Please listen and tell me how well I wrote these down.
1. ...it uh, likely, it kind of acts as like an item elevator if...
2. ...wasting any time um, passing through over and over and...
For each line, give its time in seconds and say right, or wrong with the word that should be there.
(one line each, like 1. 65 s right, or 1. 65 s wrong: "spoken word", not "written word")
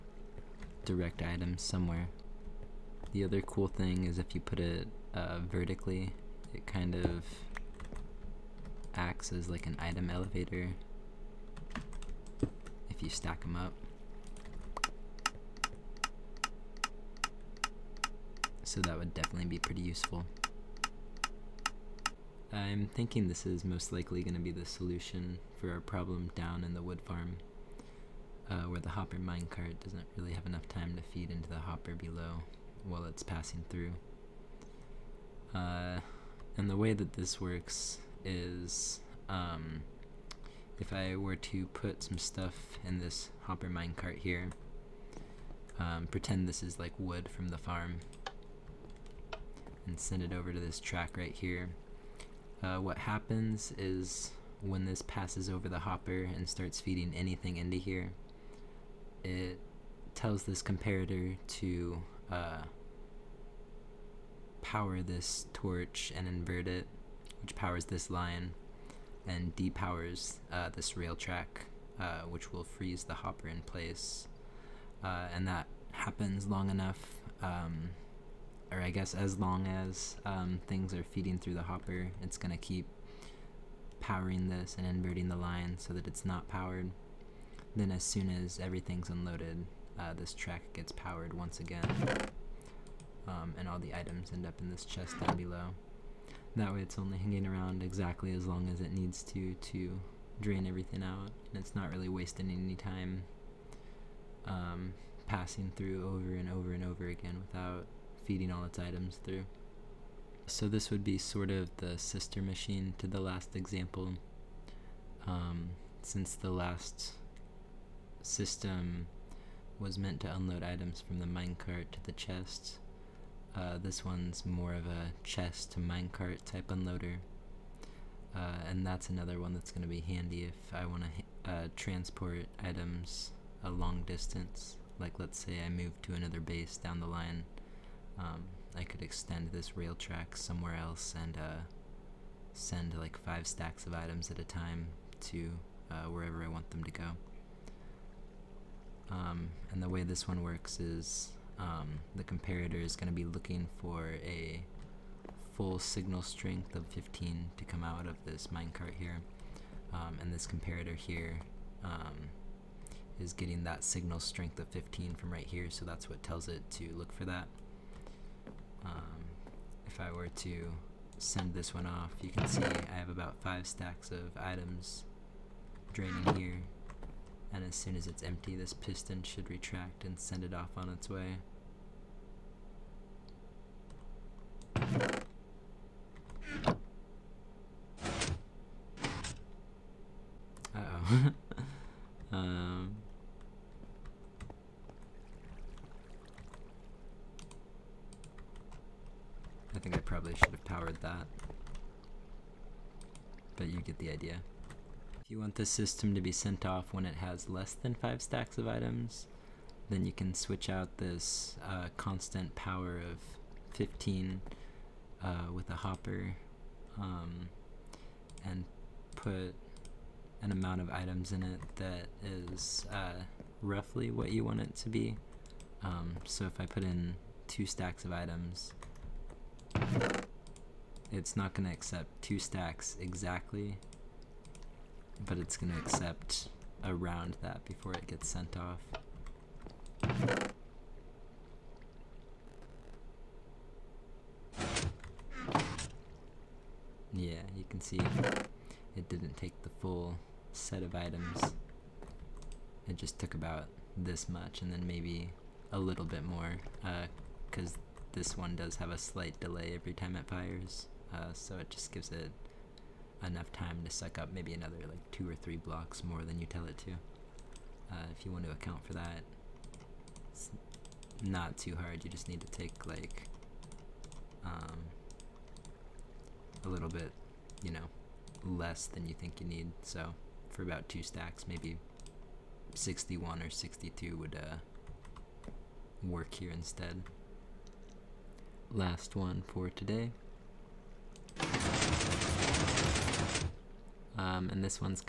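1. 4 s wrong: "vertically", not "likely"
2. 102 s right.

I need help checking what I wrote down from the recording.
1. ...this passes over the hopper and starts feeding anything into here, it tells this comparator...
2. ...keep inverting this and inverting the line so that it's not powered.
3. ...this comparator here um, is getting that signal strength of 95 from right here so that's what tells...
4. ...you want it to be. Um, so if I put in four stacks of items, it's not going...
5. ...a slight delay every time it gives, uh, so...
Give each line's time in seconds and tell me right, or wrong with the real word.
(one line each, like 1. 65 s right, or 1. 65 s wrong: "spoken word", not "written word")
1. 54 s right
2. 82 s wrong: "powering", not "inverting"
3. 160 s wrong: "15", not "95"
4. 224 s wrong: "two", not "four"
5. 258 s wrong: "fires", not "gives".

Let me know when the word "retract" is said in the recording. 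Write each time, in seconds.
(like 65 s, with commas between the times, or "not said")
179 s.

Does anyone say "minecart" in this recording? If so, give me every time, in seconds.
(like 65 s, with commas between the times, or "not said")
29 s, 43 s, 121 s, 125 s, 158 s.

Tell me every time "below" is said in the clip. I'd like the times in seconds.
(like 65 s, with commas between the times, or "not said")
31 s, 95 s.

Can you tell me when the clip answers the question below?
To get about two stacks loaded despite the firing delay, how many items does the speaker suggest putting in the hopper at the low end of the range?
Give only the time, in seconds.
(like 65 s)
282 s.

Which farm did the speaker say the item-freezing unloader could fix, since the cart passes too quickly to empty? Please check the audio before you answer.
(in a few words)
wood farm.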